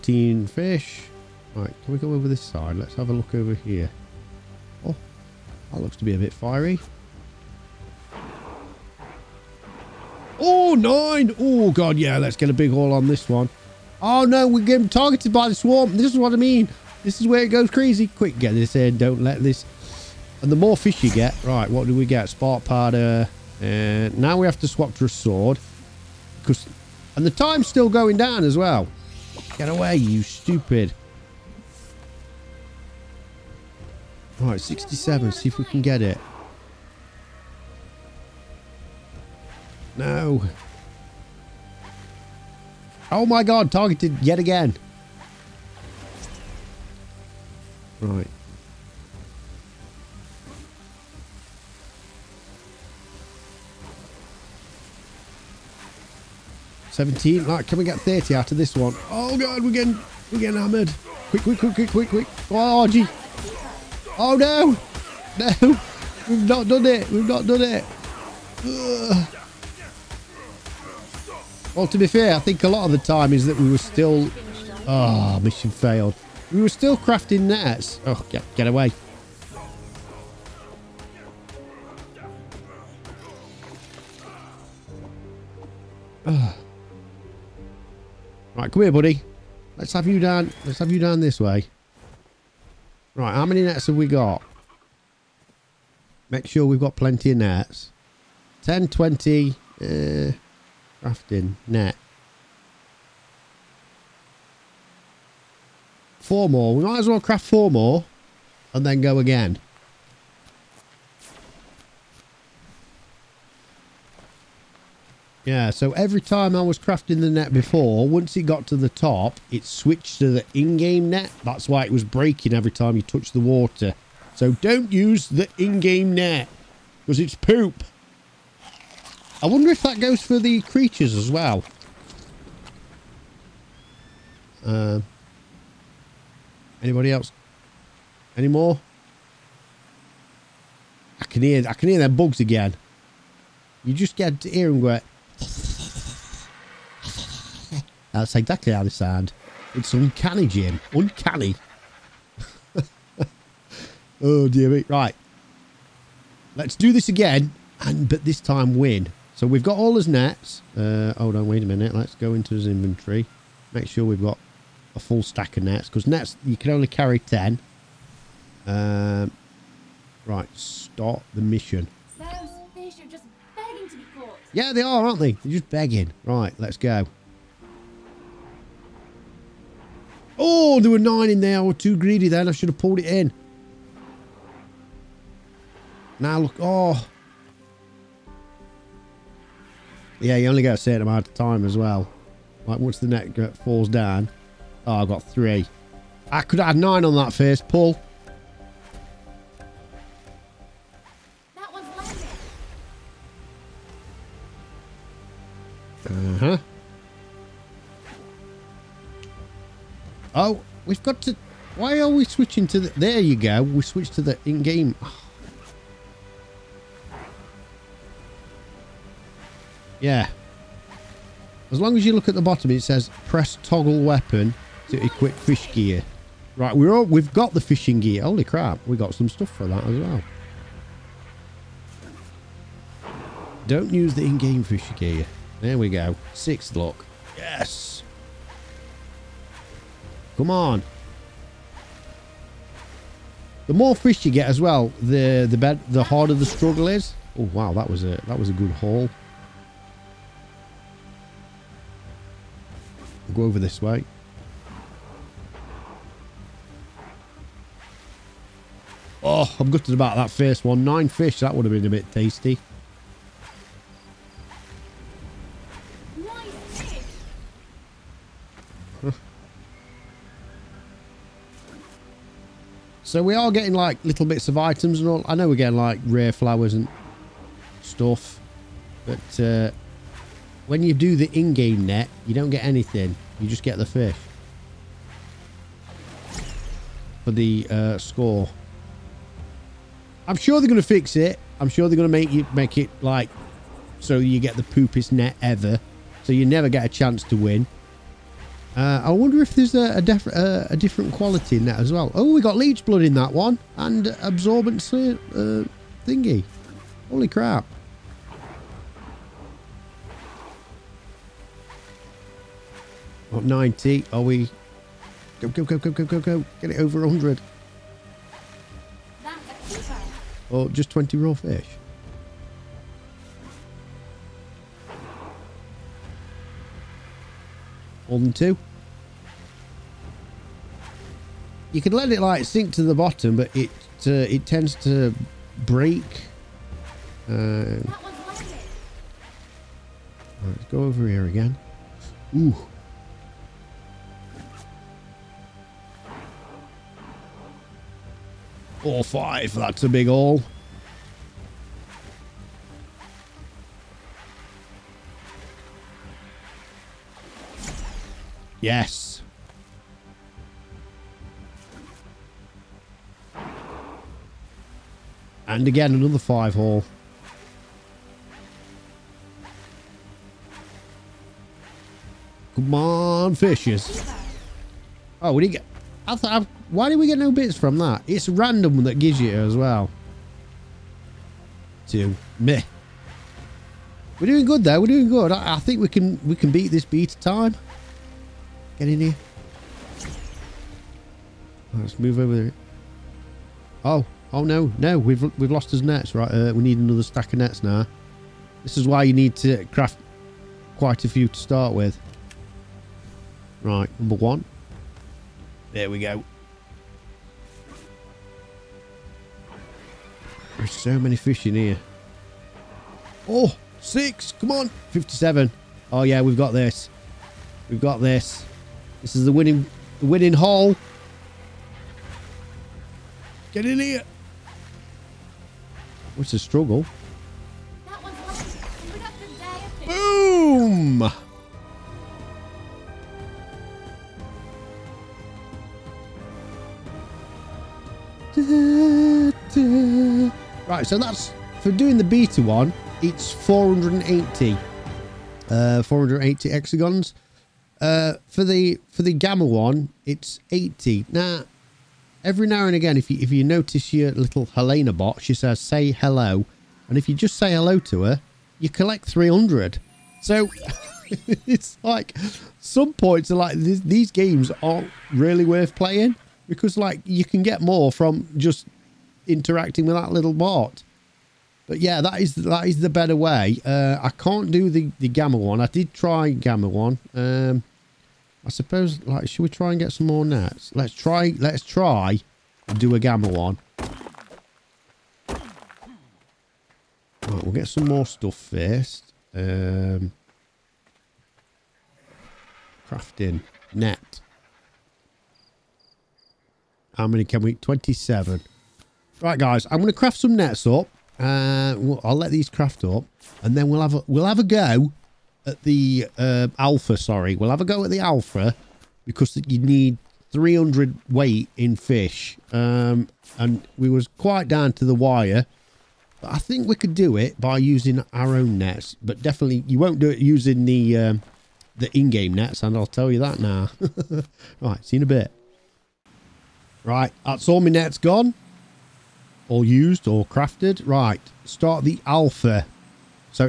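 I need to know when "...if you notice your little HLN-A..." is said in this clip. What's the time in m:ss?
7:33.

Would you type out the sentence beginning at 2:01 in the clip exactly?
That's why it was breaking every time you touched the water.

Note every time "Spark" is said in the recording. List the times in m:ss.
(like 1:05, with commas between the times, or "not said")
0:22.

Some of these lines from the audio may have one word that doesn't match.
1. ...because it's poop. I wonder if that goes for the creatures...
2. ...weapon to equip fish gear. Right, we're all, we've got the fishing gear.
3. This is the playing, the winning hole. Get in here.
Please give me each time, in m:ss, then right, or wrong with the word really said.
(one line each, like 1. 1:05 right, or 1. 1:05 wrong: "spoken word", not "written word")
1. 2:07 right
2. 3:44 right
3. 6:59 wrong: "winning", not "playing".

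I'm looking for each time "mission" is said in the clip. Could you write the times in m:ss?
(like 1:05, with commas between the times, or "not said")
1:15, 2:51.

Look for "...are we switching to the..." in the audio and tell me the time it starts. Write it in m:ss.
3:31.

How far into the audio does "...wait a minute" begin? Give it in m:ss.
2:41.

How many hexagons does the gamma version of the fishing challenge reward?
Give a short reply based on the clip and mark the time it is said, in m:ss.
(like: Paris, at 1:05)
80, at 7:30.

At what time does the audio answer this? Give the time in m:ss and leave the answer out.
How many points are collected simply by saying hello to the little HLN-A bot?
7:38.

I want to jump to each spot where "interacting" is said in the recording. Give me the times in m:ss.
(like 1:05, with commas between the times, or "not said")
7:49.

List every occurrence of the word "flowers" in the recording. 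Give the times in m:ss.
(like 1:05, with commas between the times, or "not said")
4:36.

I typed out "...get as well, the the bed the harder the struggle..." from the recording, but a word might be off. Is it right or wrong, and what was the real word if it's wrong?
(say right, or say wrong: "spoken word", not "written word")
right.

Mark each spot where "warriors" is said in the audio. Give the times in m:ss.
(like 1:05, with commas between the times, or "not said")
not said.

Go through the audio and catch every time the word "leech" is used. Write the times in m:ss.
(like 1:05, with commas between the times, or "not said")
5:02.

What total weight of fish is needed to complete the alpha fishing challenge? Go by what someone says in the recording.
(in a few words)
300.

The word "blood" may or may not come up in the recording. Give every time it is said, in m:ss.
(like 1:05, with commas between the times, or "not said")
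5:02.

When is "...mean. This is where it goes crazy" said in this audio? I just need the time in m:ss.
0:16.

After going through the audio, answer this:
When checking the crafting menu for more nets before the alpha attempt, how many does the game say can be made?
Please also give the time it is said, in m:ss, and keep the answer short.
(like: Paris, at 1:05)
27, at 8:17.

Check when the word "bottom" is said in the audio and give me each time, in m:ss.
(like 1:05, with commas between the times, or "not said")
3:42, 5:32.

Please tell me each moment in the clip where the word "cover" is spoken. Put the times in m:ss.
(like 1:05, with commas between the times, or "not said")
not said.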